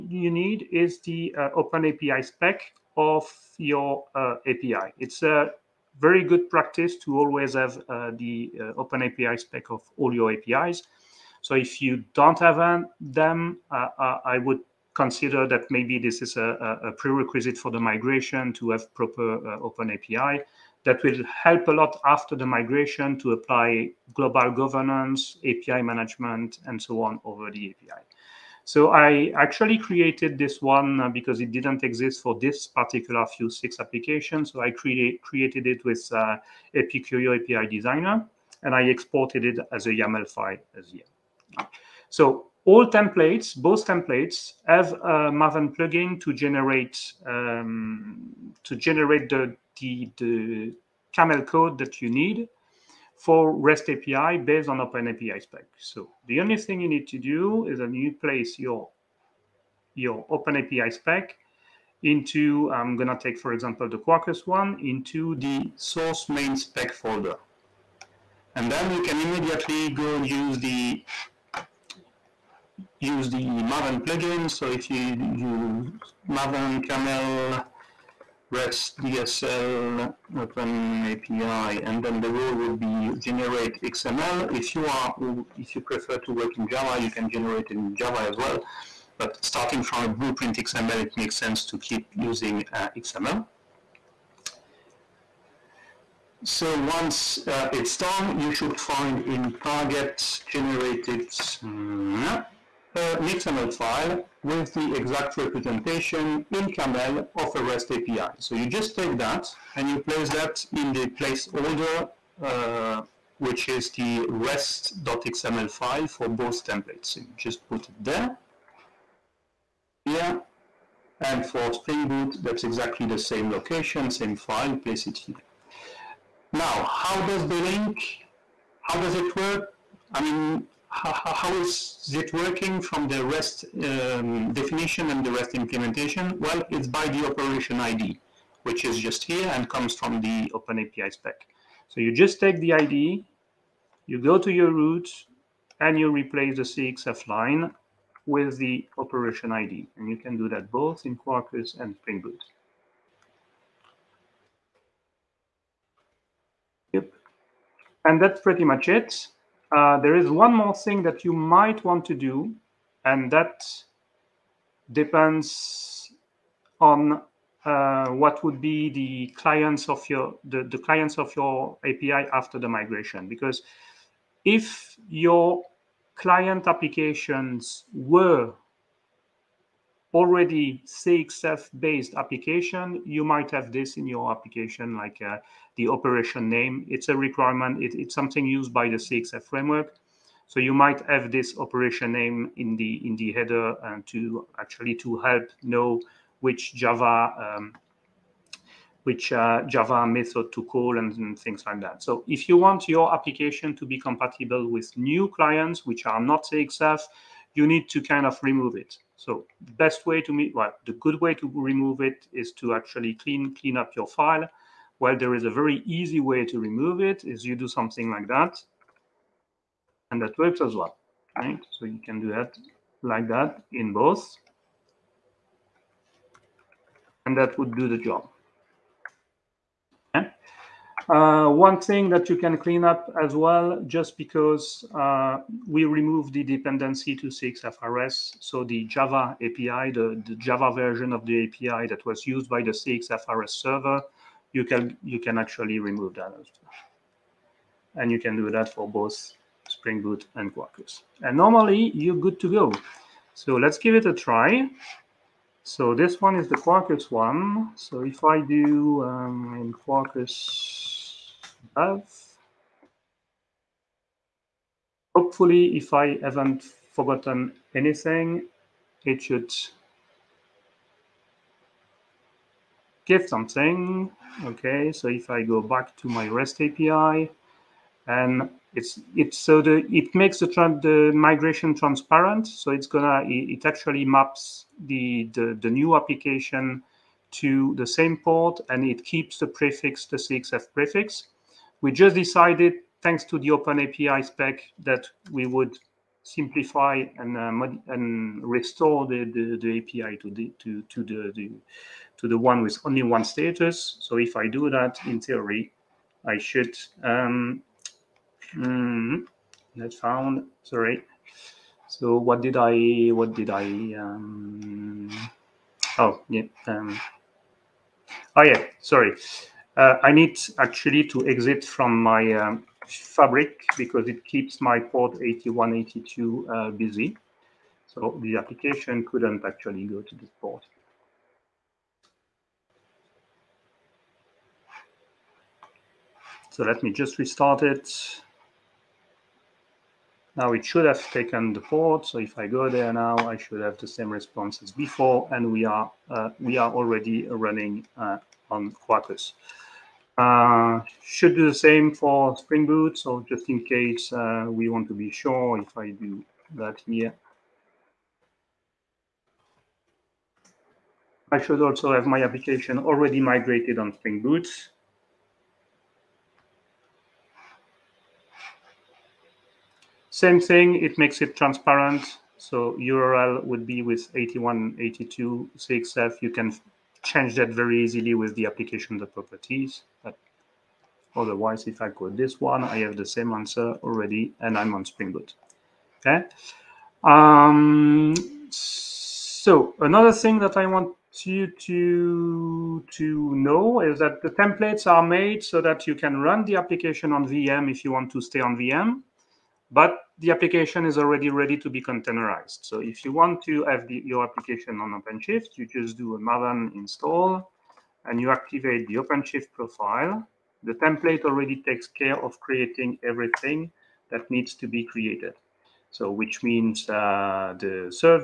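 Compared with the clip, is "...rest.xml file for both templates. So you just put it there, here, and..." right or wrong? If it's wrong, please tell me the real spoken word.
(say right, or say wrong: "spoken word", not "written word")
right.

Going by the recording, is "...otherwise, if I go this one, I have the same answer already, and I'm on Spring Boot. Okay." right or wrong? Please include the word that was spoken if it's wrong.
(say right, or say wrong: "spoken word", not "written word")
right.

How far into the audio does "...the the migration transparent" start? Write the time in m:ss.
4:40.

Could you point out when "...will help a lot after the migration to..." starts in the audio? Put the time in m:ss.
0:21.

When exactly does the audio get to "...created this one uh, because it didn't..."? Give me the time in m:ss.
0:29.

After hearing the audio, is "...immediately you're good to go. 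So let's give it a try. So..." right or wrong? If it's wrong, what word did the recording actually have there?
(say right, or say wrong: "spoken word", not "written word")
wrong: "normally", not "immediately".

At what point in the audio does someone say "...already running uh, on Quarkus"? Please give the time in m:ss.
5:46.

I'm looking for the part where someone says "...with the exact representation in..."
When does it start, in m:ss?
1:44.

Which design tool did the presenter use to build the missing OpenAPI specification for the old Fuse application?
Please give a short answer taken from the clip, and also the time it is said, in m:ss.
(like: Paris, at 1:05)
Apicurio API Designer, at 0:36.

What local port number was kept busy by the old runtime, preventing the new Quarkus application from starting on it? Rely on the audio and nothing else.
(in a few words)
8182.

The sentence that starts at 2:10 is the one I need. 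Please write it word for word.
I mean, how, how is it working from the REST um, definition and the REST implementation?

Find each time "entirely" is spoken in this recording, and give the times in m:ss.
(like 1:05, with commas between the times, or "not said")
not said.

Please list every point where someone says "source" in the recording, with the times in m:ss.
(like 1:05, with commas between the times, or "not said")
1:05.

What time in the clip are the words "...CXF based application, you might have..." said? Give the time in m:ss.
3:00.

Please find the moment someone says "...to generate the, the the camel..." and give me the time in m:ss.
0:48.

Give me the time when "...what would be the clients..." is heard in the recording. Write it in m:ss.
2:48.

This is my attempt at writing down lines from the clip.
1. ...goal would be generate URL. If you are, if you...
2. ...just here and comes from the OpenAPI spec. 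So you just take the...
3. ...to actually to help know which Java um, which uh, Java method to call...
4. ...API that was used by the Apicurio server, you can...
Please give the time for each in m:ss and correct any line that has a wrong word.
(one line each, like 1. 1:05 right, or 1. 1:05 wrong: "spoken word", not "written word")
1. 1:22 wrong: "XML", not "URL"
2. 2:18 right
3. 3:14 right
4. 4:01 wrong: "CXFRS", not "Apicurio".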